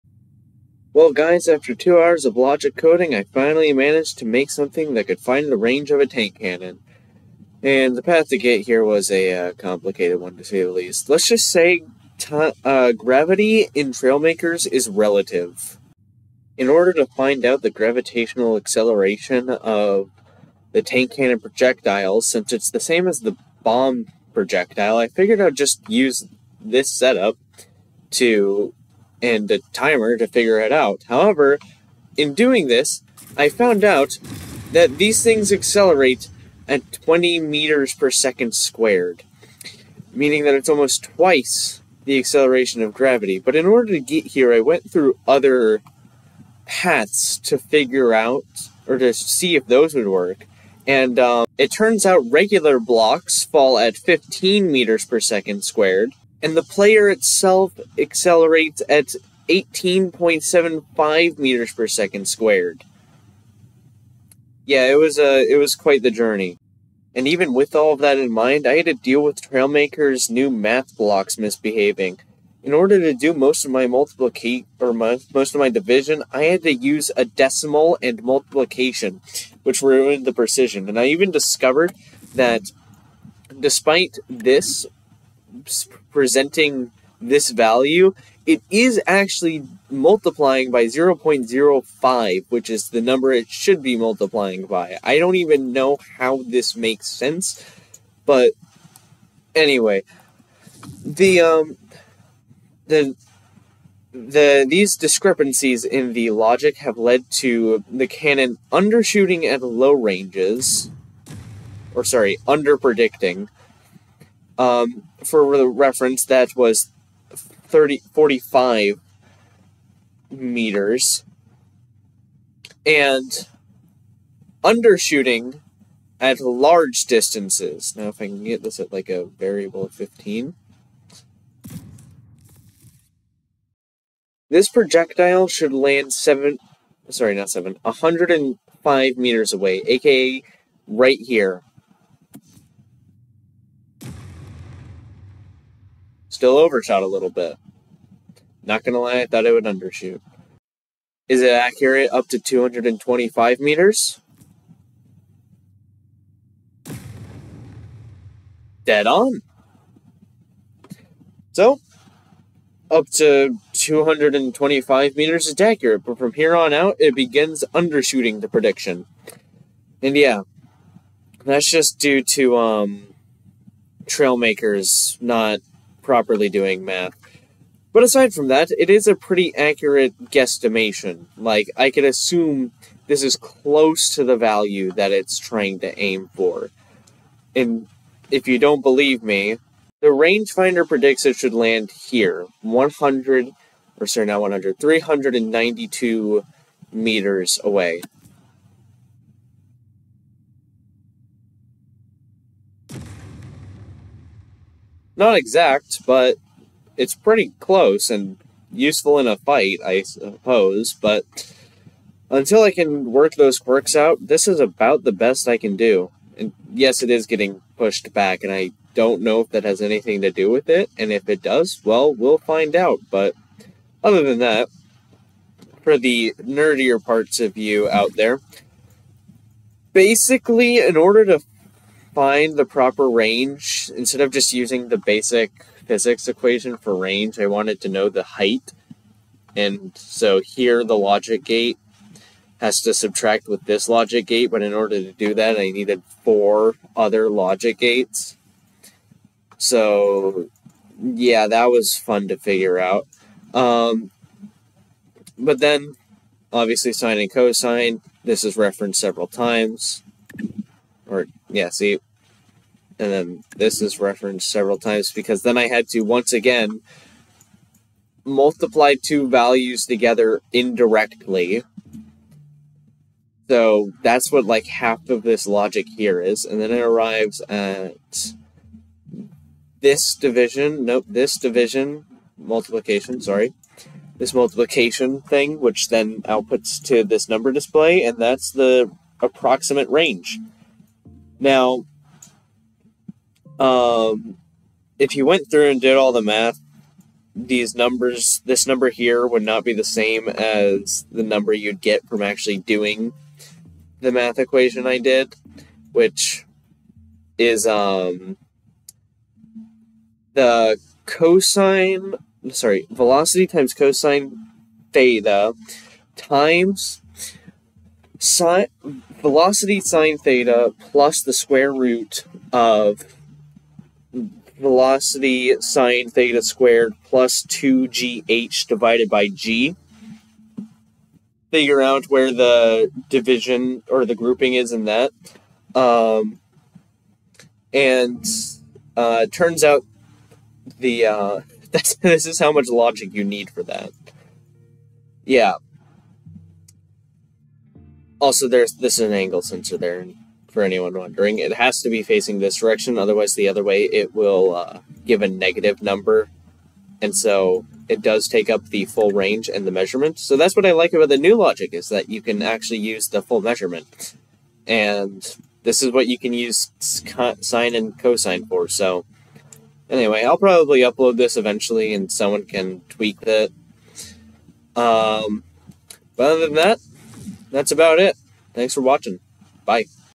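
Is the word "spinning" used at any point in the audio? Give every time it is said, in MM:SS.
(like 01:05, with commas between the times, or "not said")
not said.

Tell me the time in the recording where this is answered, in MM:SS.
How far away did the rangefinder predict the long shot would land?
03:14.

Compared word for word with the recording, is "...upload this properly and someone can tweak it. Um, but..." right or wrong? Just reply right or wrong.
wrong.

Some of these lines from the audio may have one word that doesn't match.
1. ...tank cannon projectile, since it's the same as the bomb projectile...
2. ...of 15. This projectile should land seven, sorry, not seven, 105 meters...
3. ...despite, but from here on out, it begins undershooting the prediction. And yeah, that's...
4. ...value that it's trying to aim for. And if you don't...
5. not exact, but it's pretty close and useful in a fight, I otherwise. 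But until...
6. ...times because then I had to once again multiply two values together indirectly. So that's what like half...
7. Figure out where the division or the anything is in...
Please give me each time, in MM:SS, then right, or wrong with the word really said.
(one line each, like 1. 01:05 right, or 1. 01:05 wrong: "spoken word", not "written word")
1. 00:20 right
2. 02:09 right
3. 02:45 wrong: "accurate", not "despite"
4. 03:04 right
5. 03:25 wrong: "suppose", not "otherwise"
6. 04:24 right
7. 05:31 wrong: "grouping", not "anything".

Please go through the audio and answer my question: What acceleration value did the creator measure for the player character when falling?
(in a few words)
18.75 meters per second squared.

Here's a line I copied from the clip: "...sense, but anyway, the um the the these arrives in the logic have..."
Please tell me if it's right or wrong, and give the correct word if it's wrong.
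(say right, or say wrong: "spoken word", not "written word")
wrong: "discrepancies", not "arrives".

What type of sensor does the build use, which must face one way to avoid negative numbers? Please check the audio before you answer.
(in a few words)
angle sensor.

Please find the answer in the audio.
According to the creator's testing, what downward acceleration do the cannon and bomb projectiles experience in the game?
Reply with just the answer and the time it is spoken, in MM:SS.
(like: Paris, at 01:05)
20 meters per second squared, at 00:36.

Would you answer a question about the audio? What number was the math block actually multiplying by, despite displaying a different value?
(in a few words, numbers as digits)
0.05.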